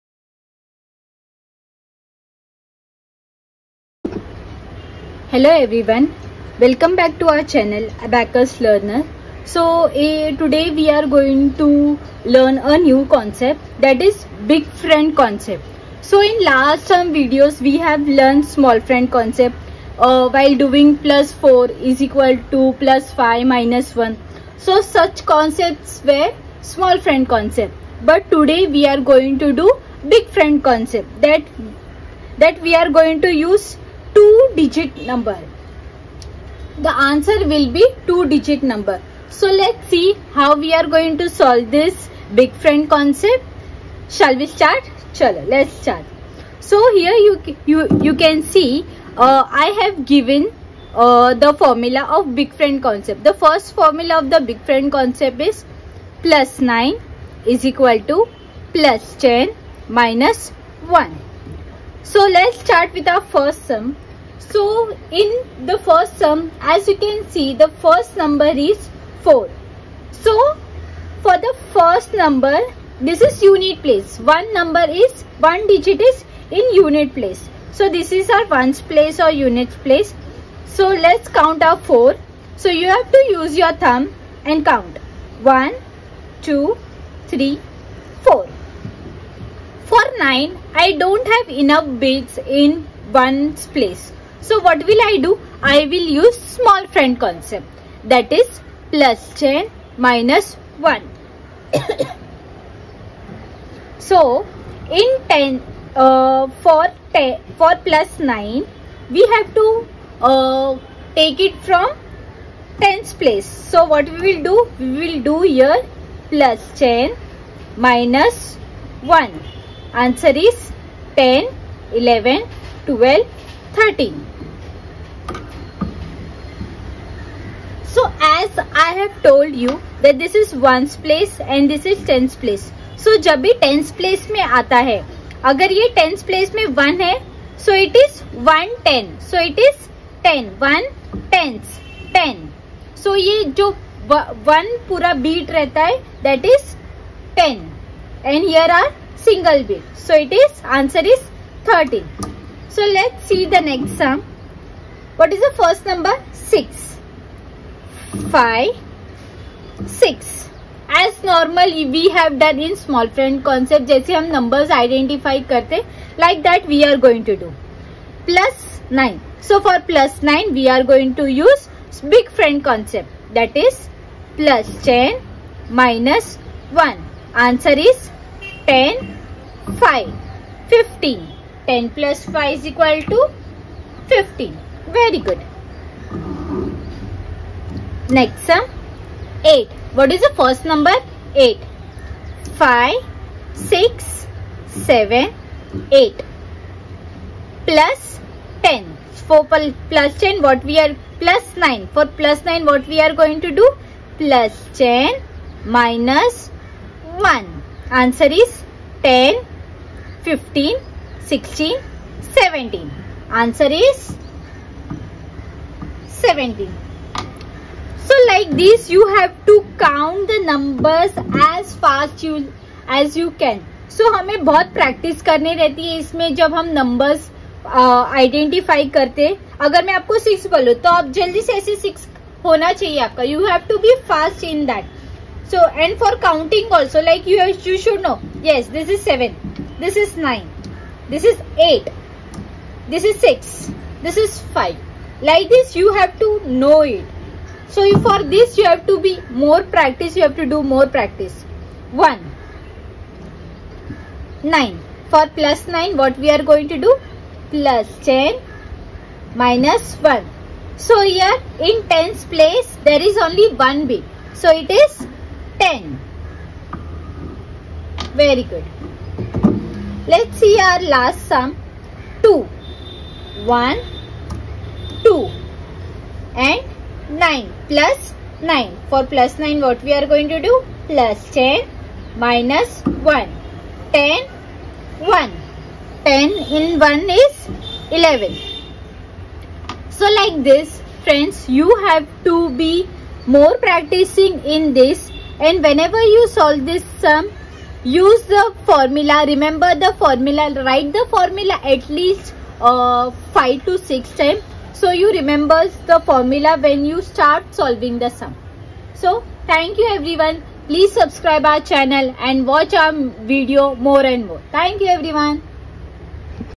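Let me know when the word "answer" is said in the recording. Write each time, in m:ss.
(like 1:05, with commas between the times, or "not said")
0:37, 1:59, 2:30, 2:57, 3:27, 3:33.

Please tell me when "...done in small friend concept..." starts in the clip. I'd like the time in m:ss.
2:42.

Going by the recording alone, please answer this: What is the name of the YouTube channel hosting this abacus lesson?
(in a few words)
Abacus Learner.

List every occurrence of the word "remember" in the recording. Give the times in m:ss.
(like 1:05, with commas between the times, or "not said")
4:59, 5:05.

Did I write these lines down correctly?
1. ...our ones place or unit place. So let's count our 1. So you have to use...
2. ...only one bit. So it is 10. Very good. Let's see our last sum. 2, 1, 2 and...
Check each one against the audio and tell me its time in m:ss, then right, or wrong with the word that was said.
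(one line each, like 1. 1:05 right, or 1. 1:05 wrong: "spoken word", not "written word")
1. 1:18 wrong: "4", not "1"
2. 4:23 right.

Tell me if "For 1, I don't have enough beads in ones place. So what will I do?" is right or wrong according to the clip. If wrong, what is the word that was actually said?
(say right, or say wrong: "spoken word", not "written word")
wrong: "9", not "1".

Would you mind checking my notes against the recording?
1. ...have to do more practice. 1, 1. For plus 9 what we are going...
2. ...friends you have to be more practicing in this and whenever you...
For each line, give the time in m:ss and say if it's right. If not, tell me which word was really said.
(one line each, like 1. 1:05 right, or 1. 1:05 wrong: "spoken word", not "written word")
1. 4:10 wrong: "9", not "1"
2. 4:51 right.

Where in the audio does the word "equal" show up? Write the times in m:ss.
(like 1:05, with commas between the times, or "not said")
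0:22, 0:57, 3:02.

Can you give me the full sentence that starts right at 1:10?
So for the first number this is unit place.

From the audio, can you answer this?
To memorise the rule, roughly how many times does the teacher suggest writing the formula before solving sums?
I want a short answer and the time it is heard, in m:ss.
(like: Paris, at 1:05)
5 to 6 times, at 5:03.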